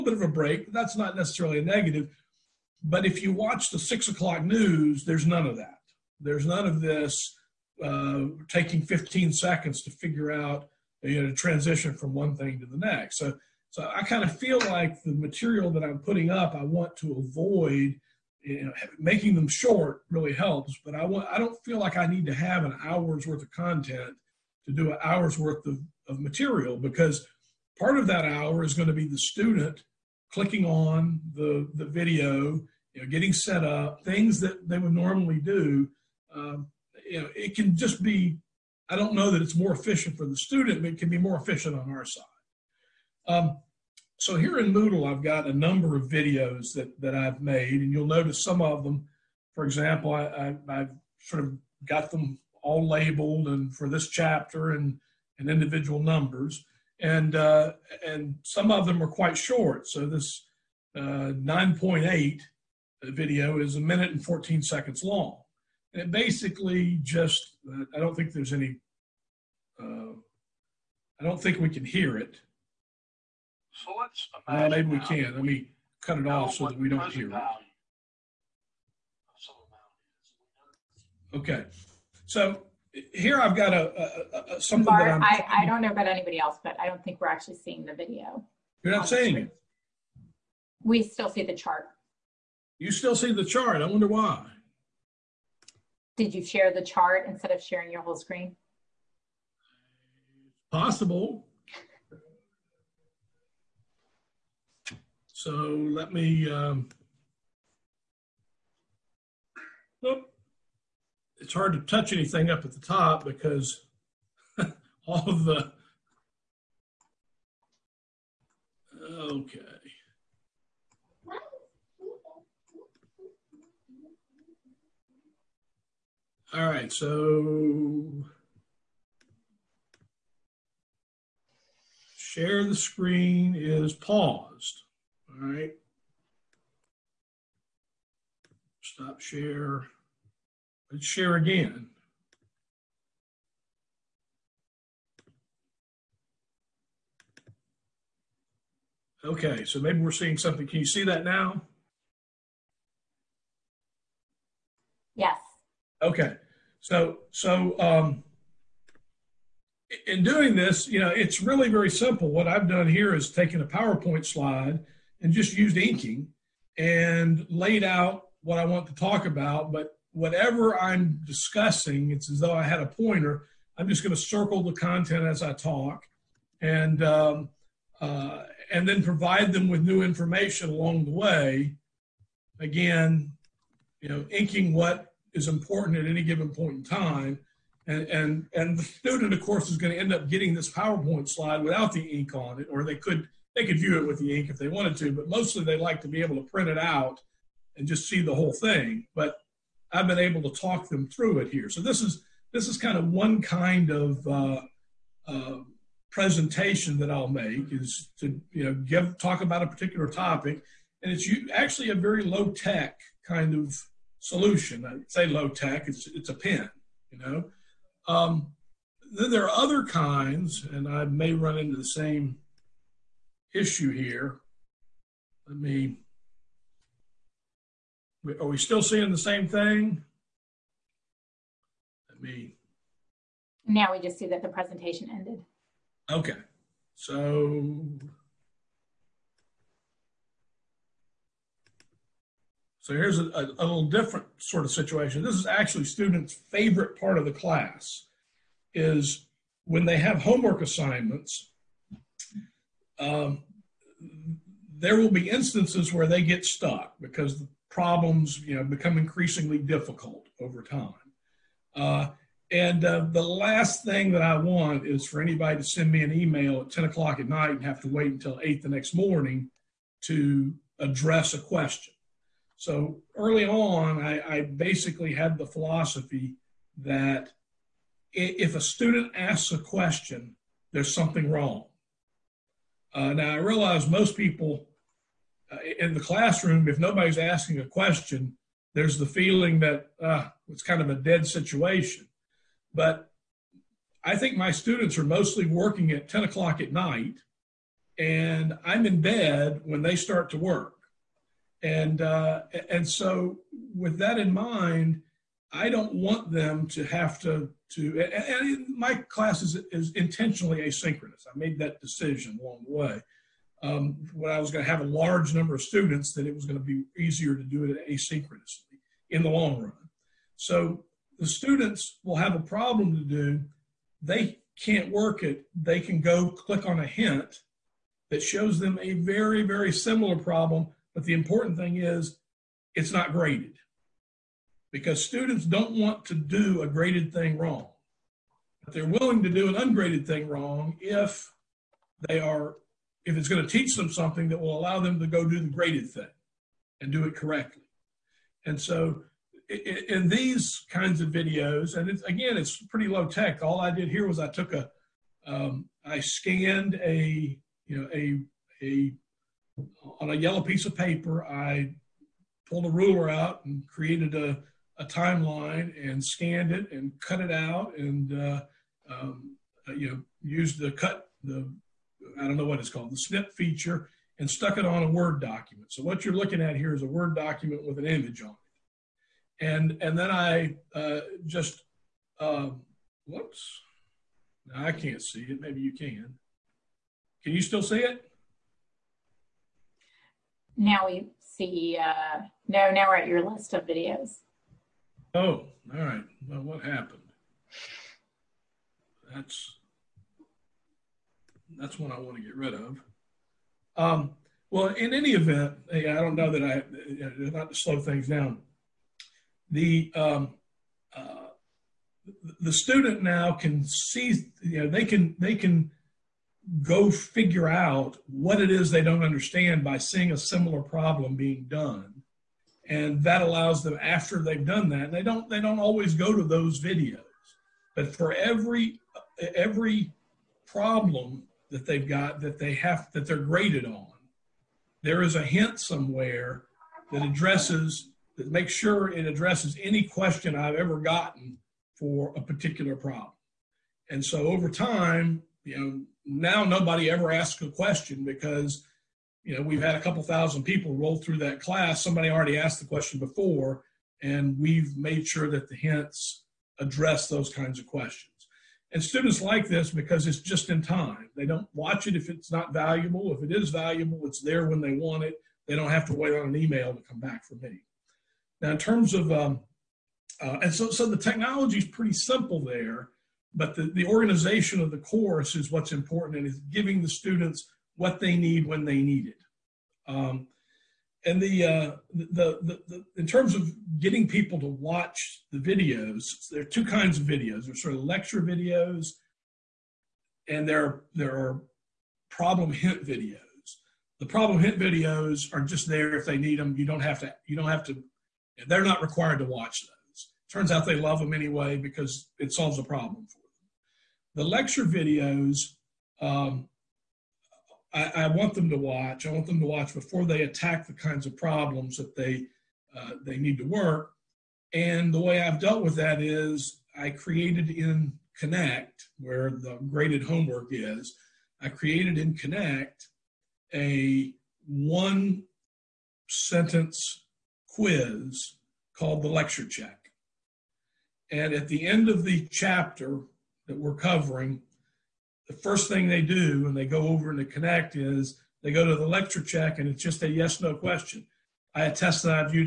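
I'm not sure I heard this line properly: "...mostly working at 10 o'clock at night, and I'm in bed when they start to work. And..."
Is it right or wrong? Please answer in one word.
right.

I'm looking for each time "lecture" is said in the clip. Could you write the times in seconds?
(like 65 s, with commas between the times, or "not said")
487 s, 504 s, 529 s, 538 s.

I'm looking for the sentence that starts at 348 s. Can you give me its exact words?
And so in these kinds of videos, and it's, again, it's pretty low tech.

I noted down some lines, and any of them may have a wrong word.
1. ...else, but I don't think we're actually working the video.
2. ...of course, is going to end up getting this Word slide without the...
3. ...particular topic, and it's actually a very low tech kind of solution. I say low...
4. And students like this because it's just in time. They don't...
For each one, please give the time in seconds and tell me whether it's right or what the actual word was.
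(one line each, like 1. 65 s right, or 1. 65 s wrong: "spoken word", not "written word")
1. 86 s wrong: "seeing", not "working"
2. 189 s wrong: "PowerPoint", not "Word"
3. 209 s right
4. 458 s right.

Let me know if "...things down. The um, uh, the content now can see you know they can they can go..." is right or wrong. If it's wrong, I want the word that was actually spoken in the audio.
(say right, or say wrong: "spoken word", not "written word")
wrong: "student", not "content".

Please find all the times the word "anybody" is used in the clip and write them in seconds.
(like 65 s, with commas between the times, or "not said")
86 s, 265 s.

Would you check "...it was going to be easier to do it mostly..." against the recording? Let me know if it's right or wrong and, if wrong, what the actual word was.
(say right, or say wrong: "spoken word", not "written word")
wrong: "asynchronously", not "mostly".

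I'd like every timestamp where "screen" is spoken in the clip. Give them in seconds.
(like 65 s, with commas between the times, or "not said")
98 s, 132 s.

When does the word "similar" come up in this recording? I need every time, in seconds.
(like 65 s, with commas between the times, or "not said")
329 s, 420 s.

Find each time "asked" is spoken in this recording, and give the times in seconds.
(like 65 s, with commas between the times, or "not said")
452 s.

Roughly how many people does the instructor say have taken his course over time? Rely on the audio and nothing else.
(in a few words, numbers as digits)
a couple thousand.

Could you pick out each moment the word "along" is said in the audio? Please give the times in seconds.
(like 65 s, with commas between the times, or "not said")
180 s, 312 s.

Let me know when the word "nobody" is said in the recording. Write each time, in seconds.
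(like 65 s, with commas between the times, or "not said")
286 s, 446 s.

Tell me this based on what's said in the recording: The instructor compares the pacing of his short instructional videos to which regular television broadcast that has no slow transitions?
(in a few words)
six o'clock news.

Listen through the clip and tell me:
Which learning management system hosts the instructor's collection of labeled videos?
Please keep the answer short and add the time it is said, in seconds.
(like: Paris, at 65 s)
Moodle, at 44 s.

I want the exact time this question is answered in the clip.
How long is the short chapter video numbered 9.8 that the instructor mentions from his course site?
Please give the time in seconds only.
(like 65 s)
63 s.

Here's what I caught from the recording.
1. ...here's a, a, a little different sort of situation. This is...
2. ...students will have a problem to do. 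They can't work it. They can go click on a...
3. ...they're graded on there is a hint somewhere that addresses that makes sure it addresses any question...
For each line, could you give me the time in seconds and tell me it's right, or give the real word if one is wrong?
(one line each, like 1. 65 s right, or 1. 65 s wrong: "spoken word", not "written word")
1. 242 s right
2. 321 s right
3. 433 s right.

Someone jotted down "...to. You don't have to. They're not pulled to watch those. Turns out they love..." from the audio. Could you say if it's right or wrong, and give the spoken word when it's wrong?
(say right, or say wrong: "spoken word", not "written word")
wrong: "required", not "pulled".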